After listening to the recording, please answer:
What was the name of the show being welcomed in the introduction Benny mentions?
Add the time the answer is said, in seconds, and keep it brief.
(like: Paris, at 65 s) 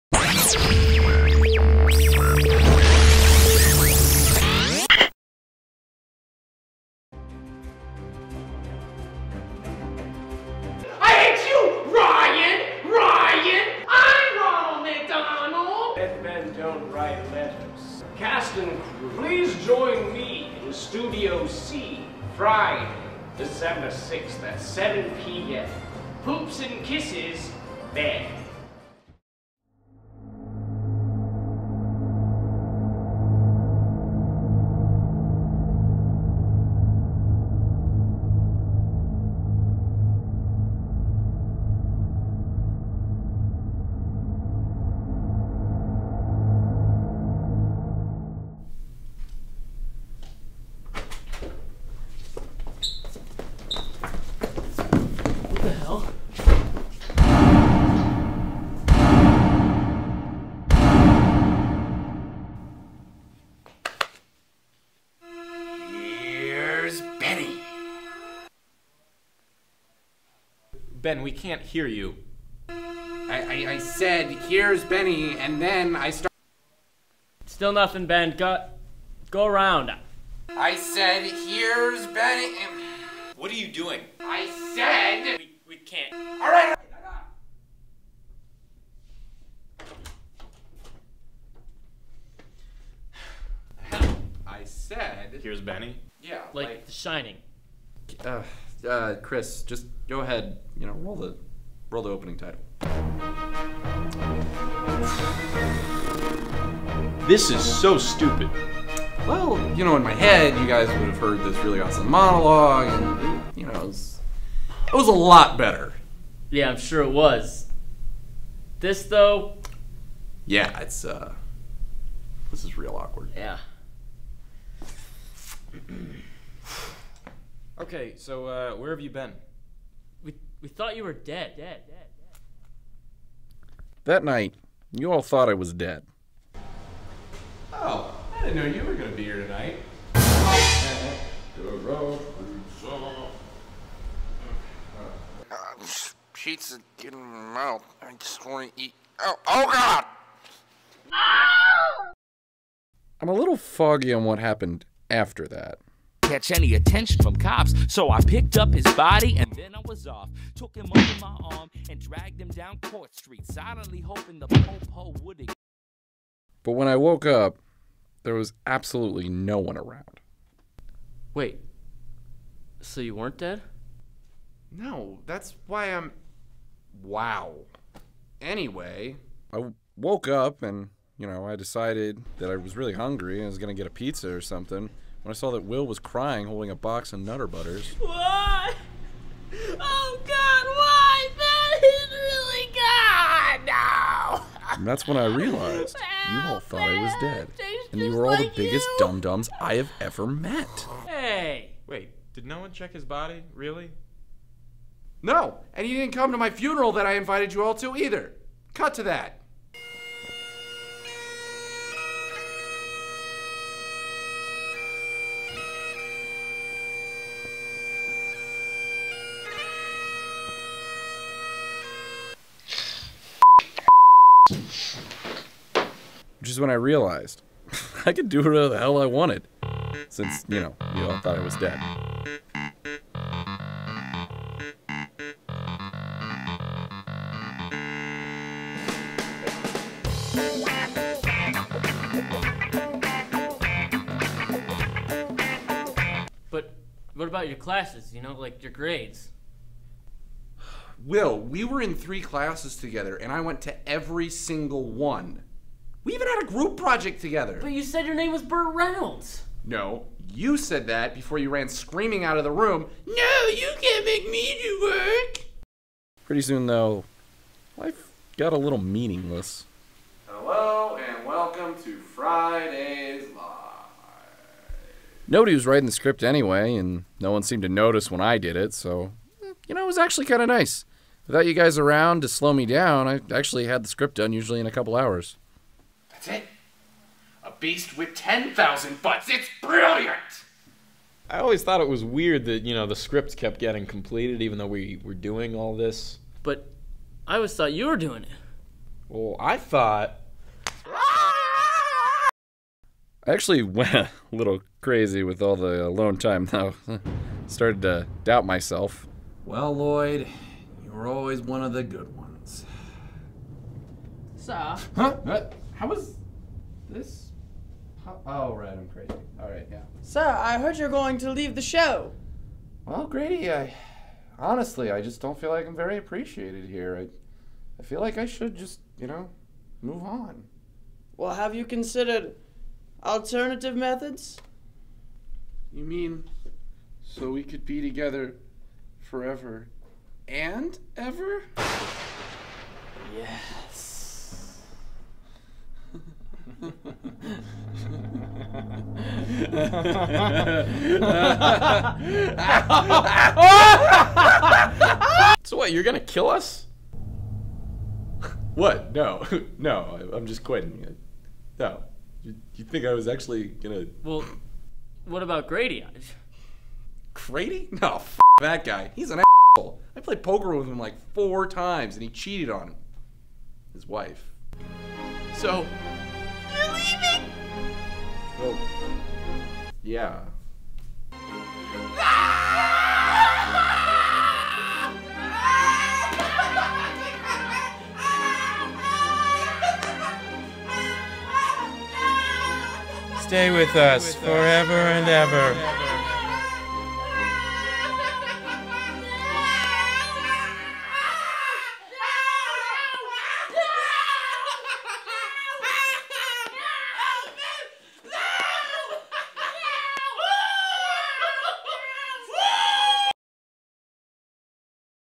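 Friday's Live, at 271 s.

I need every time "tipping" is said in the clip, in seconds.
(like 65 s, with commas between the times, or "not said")
not said.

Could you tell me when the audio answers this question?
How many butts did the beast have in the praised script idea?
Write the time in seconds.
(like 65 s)
288 s.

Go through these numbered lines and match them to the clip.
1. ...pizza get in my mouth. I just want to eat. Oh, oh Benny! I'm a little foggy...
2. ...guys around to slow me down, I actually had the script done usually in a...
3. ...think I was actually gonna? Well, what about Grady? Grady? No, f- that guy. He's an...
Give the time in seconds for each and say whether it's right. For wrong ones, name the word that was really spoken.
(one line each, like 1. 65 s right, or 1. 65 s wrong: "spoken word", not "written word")
1. 146 s wrong: "God", not "Benny"
2. 281 s right
3. 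362 s right.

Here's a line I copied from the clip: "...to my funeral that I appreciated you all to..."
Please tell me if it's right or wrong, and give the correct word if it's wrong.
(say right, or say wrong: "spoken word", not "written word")
wrong: "invited", not "appreciated".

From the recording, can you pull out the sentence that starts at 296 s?
But I always thought you were doing it.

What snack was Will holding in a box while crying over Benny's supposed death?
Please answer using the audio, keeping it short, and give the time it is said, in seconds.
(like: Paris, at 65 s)
Nutter Butters, at 187 s.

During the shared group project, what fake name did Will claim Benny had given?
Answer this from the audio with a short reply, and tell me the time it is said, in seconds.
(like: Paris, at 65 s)
Burt Reynolds, at 258 s.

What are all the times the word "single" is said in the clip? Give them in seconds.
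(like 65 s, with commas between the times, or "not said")
254 s.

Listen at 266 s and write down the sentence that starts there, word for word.
Pretty soon, though, life got a little meaningless.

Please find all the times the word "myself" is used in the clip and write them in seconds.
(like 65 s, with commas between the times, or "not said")
308 s.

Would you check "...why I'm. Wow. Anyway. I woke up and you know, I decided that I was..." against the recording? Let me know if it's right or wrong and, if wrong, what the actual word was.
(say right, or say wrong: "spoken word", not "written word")
right.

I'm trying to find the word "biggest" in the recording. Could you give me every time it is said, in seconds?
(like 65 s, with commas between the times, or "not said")
198 s.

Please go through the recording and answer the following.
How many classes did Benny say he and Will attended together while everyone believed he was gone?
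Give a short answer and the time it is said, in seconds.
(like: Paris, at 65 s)
3, at 251 s.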